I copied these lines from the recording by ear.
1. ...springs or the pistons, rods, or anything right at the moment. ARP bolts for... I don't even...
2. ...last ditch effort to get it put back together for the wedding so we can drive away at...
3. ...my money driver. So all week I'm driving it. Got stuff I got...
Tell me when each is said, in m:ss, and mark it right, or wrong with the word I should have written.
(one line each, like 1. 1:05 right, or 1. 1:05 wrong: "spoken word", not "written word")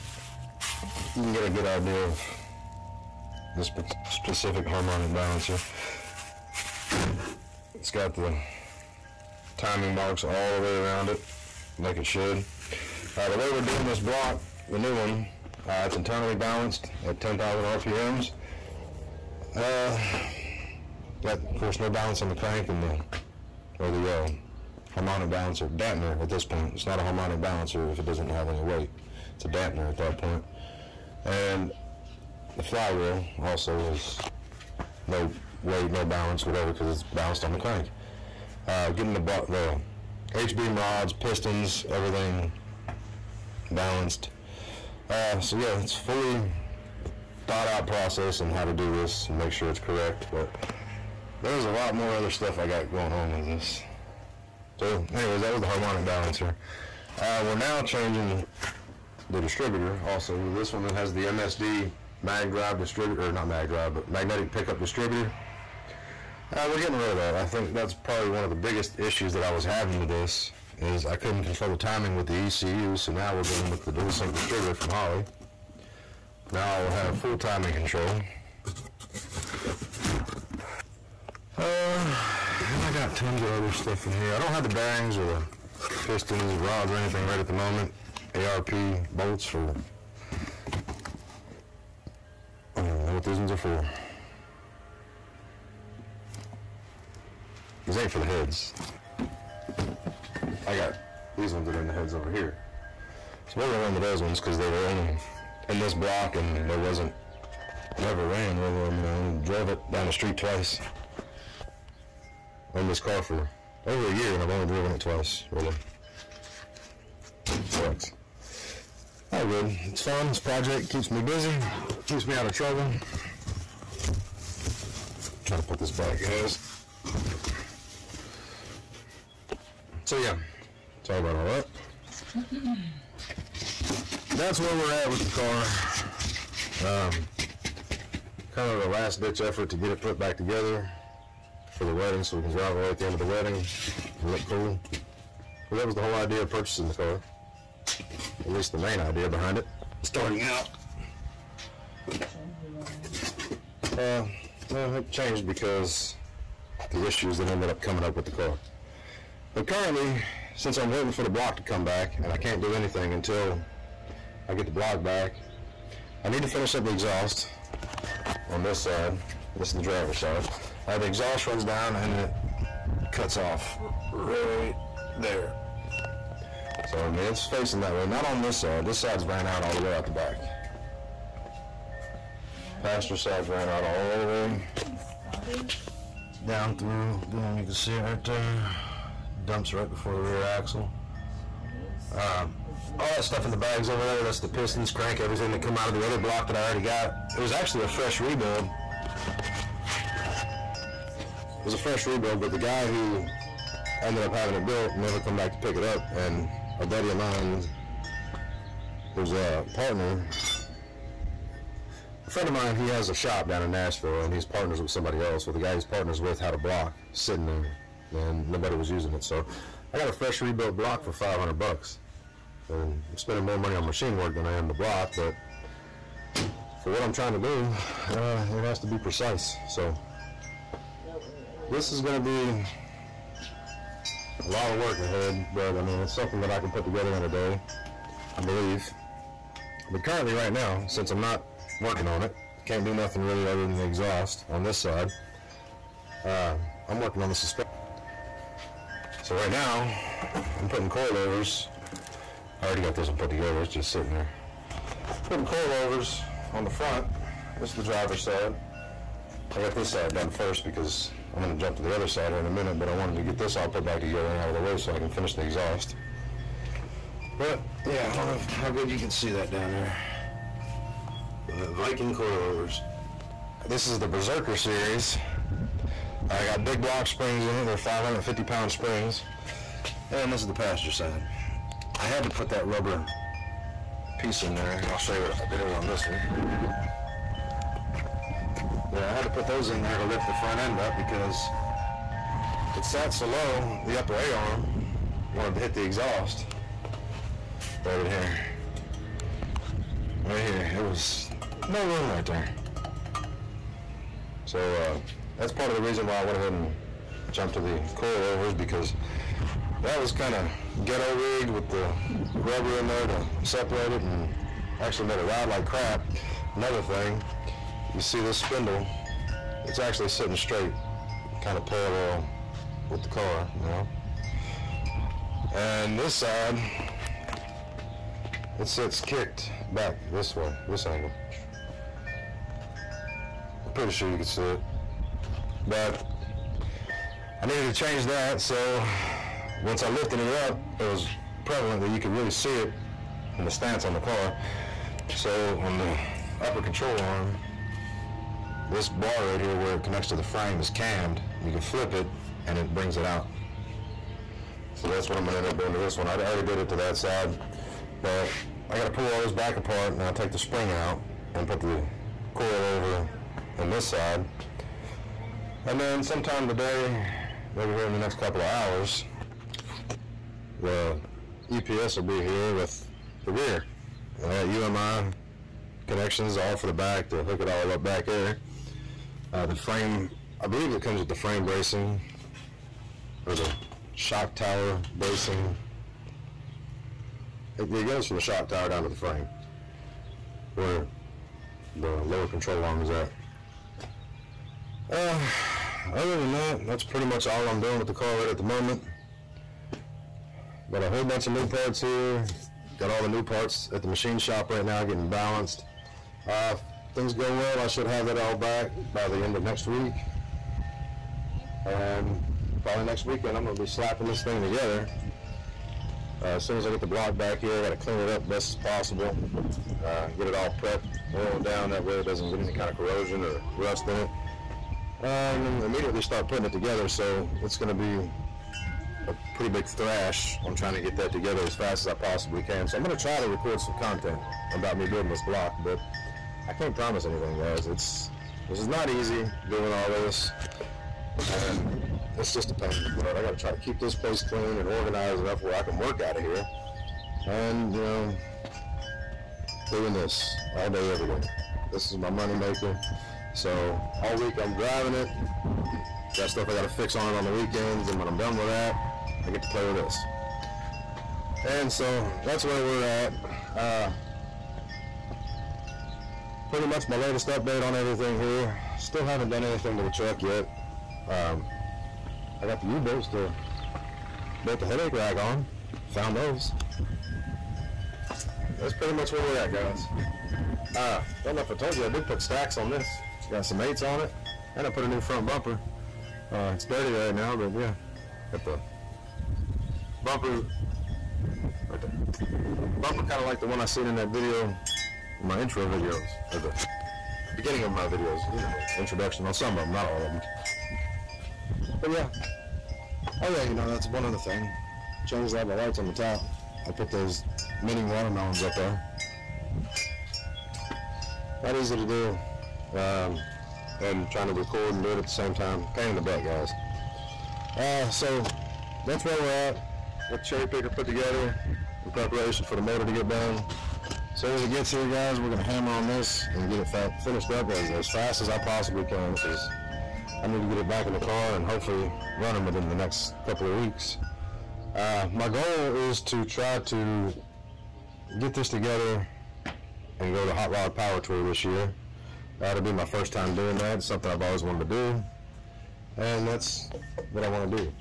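1. 1:24 wrong: "bearings", not "springs"
2. 2:18 right
3. 7:31 wrong: "maker", not "driver".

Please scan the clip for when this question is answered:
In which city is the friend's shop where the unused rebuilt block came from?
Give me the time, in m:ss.
3:33.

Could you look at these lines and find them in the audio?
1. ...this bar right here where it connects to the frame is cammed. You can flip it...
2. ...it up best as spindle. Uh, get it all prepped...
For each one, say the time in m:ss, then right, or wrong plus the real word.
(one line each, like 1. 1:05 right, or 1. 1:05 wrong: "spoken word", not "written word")
1. 5:48 right
2. 6:57 wrong: "possible", not "spindle".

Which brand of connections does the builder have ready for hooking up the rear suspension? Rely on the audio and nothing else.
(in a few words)
UMI.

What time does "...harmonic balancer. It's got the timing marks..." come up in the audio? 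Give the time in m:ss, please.
0:04.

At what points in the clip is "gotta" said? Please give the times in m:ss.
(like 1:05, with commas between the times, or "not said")
5:58, 6:57.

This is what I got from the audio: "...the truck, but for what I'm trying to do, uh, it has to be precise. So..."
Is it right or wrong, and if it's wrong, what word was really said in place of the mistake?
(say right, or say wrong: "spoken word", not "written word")
wrong: "block", not "truck".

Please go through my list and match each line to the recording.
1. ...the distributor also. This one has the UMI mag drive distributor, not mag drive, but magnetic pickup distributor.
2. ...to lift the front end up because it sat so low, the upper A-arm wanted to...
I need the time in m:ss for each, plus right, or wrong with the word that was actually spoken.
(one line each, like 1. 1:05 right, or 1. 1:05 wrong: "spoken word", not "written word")
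1. 0:59 wrong: "MSD", not "UMI"
2. 4:49 right.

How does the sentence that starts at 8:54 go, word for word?
Uh, my goal is to try to get this together and go to Hot Rod Power Tour this year.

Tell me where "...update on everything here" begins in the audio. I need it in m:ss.
7:47.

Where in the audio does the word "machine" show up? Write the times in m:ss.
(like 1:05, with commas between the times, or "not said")
3:43, 6:43.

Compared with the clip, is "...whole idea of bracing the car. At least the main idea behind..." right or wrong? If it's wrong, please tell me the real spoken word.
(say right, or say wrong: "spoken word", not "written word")
wrong: "purchasing", not "bracing".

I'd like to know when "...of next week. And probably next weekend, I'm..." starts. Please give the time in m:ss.
6:49.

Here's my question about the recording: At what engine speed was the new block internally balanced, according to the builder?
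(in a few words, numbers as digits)
10,000 RPM.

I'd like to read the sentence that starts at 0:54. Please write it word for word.
So anyways, that was the harmonic balancer.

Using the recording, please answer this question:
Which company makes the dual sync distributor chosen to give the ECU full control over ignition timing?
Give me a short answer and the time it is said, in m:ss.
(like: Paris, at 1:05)
Holley, at 1:14.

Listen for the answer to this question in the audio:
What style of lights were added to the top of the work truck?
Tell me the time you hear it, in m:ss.
8:27.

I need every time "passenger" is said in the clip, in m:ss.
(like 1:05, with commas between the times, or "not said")
3:02, 4:40.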